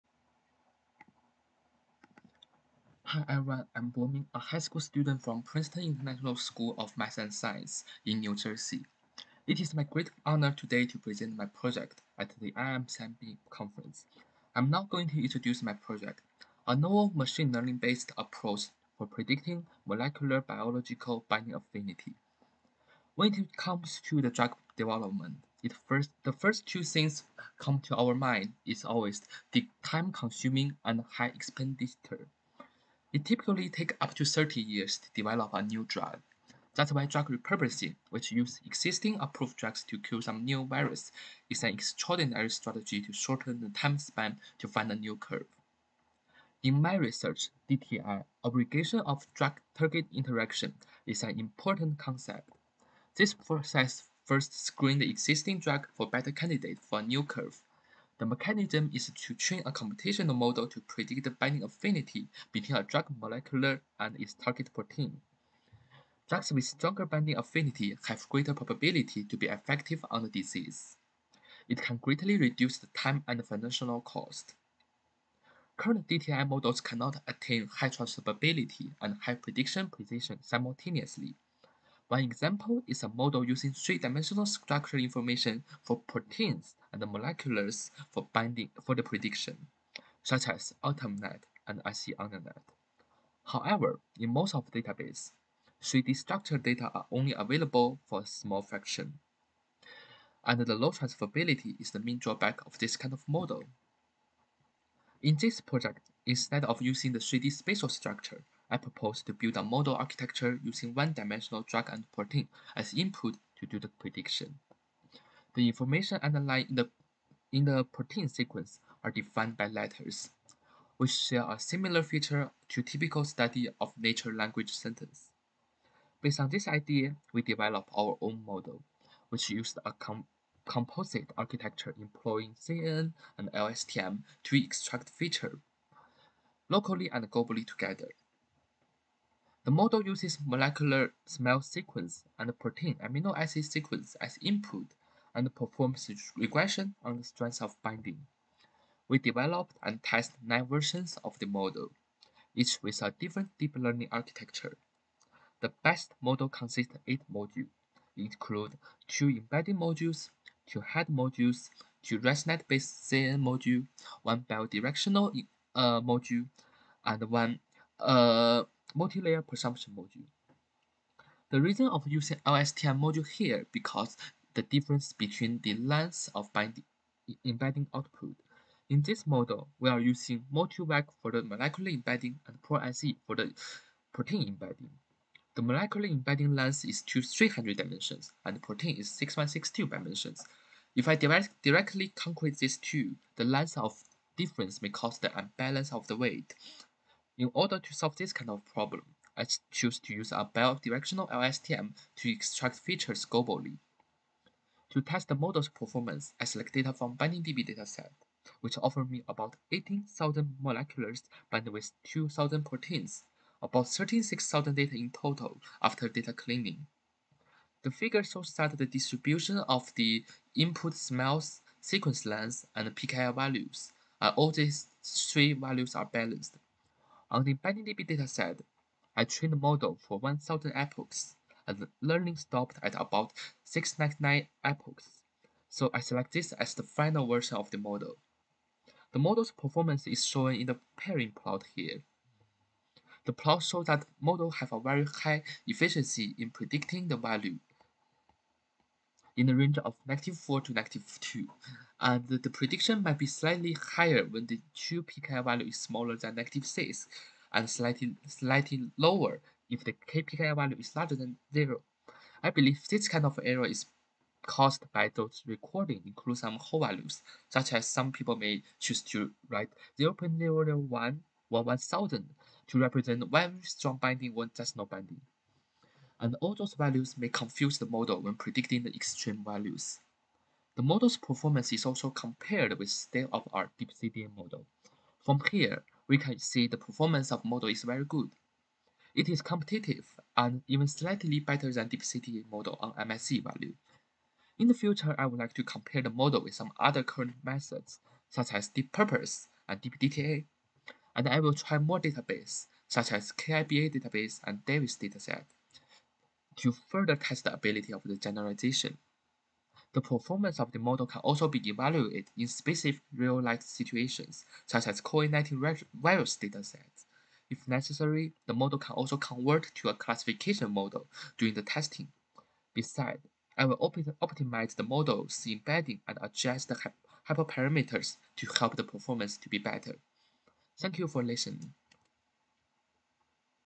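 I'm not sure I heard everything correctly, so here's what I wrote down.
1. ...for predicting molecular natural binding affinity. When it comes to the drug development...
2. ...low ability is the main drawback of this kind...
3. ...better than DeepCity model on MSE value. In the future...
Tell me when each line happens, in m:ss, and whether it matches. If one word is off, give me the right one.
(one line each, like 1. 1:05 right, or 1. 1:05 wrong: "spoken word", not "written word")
1. 0:18 wrong: "biological", not "natural"
2. 1:40 wrong: "transferability", not "ability"
3. 4:51 right.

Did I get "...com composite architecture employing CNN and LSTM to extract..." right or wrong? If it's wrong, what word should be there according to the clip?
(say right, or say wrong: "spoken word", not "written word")
right.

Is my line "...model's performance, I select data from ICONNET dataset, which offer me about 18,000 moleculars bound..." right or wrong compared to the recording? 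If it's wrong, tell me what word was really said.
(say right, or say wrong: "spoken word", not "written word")
wrong: "BindingDB", not "ICONNET".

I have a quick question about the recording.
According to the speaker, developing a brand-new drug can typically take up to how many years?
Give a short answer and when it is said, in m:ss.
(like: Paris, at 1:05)
30, at 0:34.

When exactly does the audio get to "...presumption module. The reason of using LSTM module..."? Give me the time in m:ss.
2:49.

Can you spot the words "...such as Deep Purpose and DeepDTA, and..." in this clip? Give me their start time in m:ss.
4:58.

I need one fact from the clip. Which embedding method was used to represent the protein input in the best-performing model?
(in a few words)
ProSE.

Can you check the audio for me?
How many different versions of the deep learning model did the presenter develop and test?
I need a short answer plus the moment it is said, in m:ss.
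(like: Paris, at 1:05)
9, at 2:30.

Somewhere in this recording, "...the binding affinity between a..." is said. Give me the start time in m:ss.
1:01.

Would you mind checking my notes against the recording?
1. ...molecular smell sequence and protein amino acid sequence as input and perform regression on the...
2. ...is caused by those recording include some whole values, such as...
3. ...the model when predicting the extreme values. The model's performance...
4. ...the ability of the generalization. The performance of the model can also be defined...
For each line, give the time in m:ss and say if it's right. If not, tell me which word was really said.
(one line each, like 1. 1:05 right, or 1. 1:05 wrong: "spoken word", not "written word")
1. 2:20 right
2. 4:23 right
3. 4:37 right
4. 5:07 wrong: "evaluated", not "defined".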